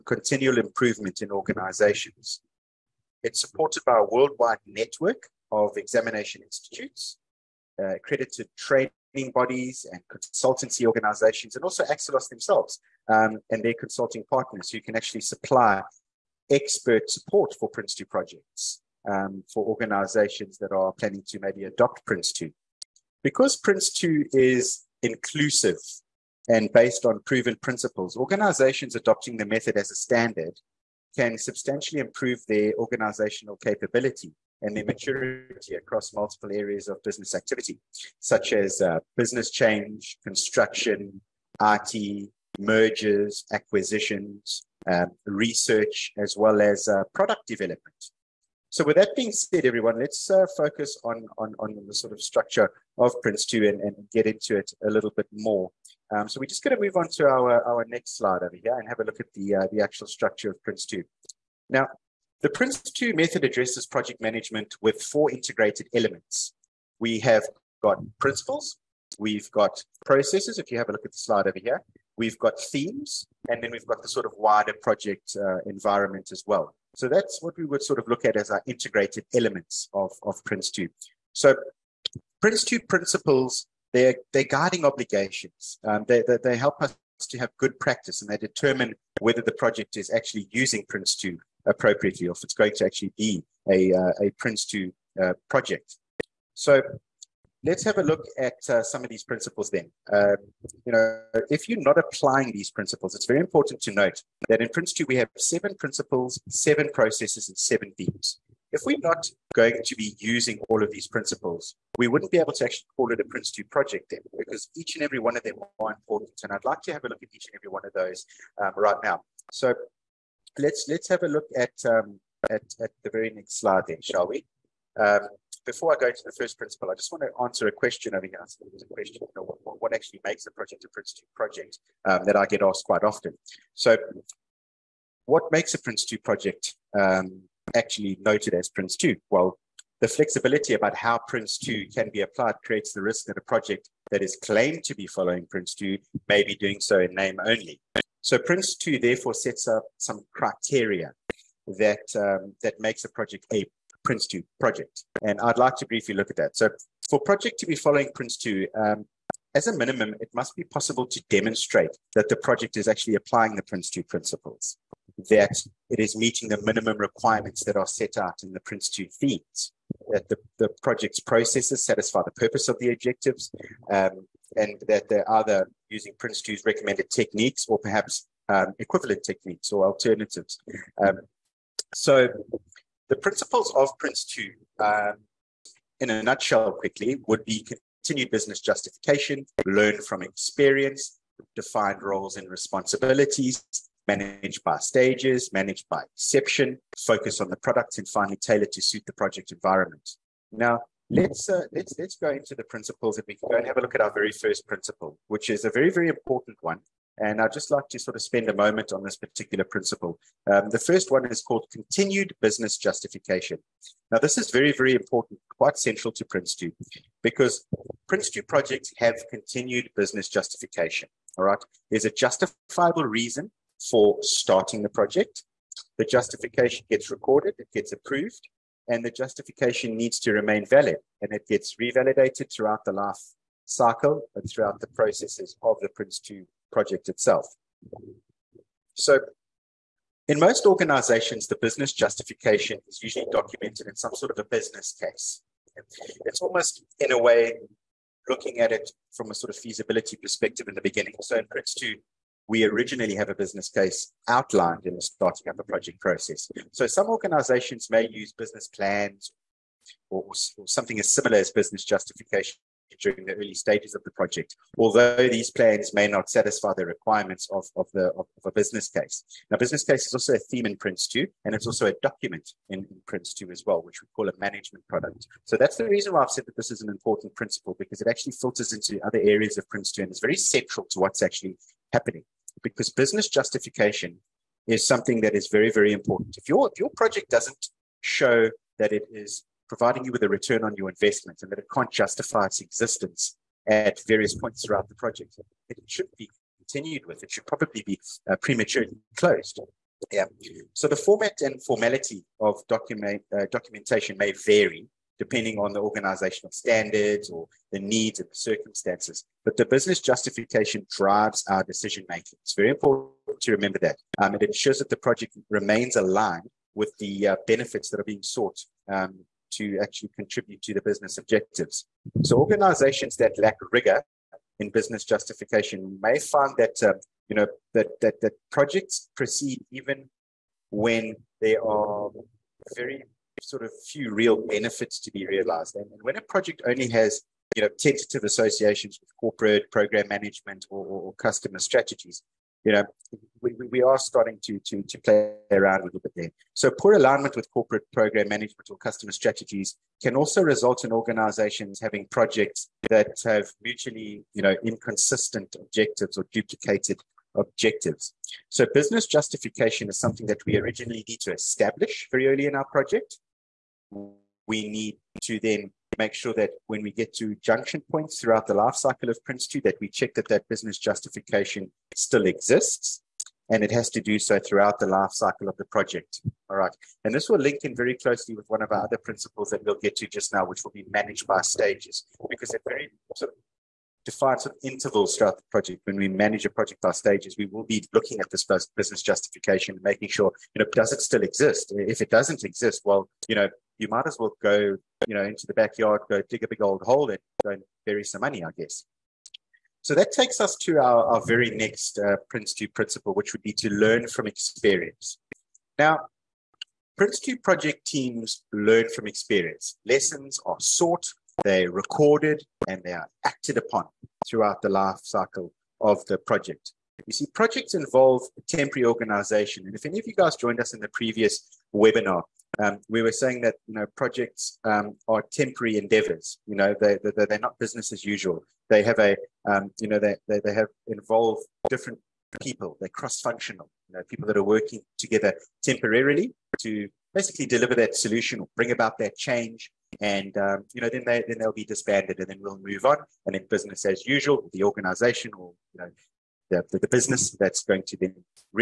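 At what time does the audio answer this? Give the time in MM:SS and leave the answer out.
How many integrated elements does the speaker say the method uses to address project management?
01:04.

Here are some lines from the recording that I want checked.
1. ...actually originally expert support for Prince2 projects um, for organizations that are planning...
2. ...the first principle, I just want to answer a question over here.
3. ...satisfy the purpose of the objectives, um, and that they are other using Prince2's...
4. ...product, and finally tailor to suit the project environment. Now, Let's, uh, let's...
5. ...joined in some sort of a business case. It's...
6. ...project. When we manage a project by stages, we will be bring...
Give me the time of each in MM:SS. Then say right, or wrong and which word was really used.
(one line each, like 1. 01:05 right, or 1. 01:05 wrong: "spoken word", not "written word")
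1. 00:14 wrong: "supply", not "originally"
2. 02:06 right
3. 02:51 right
4. 03:17 right
5. 04:03 wrong: "documented", not "joined"
6. 06:25 wrong: "looking", not "bring".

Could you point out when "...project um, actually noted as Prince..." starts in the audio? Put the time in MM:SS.
02:16.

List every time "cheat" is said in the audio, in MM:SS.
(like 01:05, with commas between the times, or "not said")
not said.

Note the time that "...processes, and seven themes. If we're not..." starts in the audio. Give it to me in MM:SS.
01:46.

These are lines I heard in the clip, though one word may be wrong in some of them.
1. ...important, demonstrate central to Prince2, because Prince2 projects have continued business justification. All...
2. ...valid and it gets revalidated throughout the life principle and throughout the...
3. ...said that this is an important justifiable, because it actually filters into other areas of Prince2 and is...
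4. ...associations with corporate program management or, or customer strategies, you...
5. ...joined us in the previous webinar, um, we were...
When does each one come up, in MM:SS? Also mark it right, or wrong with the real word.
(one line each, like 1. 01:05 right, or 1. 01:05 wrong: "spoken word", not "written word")
1. 03:34 wrong: "quite", not "demonstrate"
2. 03:50 wrong: "cycle", not "principle"
3. 04:36 wrong: "principle", not "justifiable"
4. 05:38 right
5. 07:00 right.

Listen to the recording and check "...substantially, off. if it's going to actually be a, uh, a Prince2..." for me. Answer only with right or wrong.
wrong.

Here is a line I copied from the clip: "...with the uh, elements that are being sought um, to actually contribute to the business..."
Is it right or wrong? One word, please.
wrong.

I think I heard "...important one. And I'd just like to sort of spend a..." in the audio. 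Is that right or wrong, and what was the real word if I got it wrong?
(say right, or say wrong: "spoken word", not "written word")
right.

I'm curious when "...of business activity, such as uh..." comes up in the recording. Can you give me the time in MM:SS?
00:36.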